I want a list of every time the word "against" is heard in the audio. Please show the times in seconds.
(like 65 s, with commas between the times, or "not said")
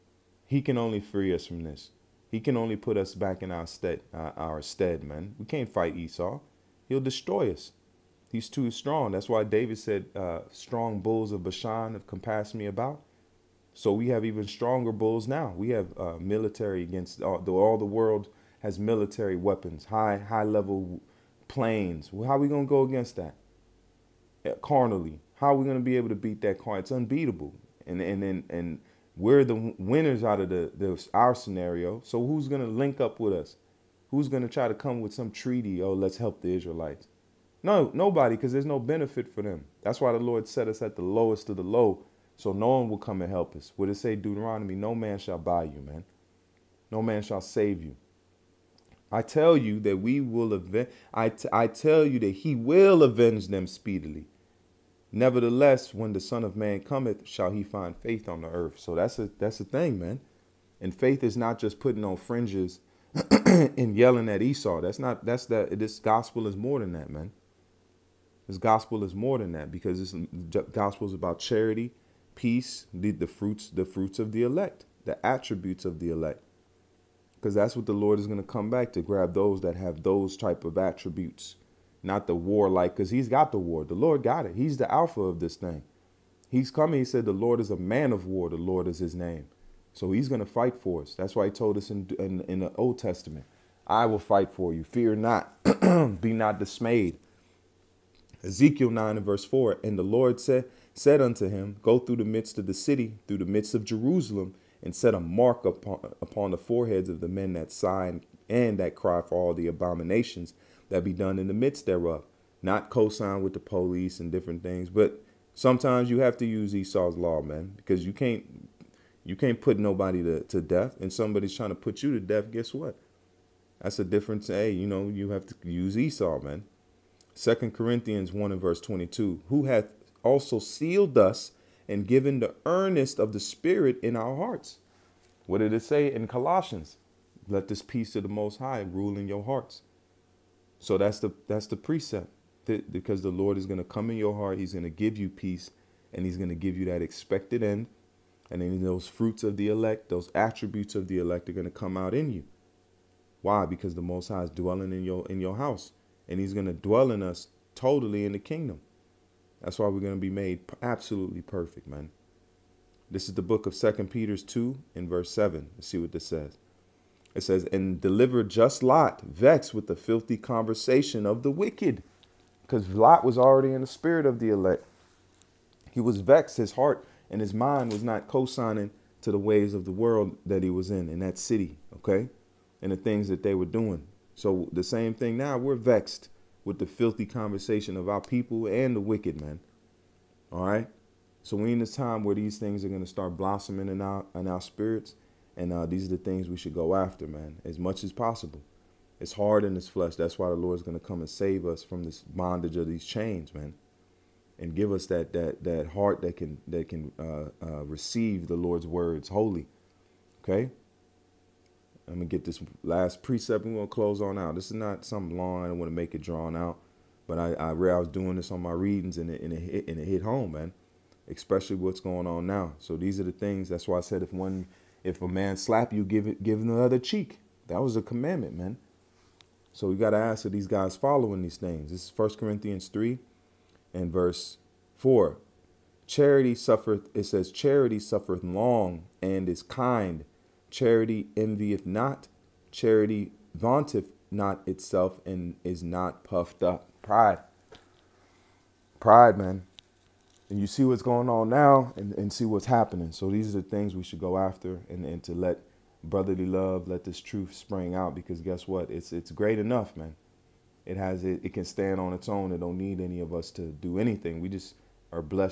16 s, 22 s.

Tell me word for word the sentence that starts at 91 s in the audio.
That's why he told us in, in, in the Old Testament, I will fight for you.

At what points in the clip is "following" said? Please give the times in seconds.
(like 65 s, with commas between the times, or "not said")
230 s.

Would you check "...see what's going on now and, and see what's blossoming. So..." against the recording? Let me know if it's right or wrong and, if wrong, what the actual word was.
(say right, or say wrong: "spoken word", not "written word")
wrong: "happening", not "blossoming".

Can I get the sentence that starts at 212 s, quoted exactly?
I'm gonna get this last precept we're gonna close on out.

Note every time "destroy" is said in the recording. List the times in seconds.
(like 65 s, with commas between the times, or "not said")
7 s.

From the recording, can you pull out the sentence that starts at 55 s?
Nevertheless, when the Son of Man cometh, shall he find faith on the earth.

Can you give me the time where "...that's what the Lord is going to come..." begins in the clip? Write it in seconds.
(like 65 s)
77 s.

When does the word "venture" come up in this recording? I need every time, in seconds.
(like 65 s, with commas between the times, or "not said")
not said.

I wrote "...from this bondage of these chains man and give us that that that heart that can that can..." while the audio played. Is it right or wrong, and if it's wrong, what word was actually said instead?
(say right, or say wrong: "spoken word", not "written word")
right.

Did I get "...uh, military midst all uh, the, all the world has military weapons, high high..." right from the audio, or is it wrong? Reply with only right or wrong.
wrong.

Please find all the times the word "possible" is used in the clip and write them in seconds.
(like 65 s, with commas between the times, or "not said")
198 s.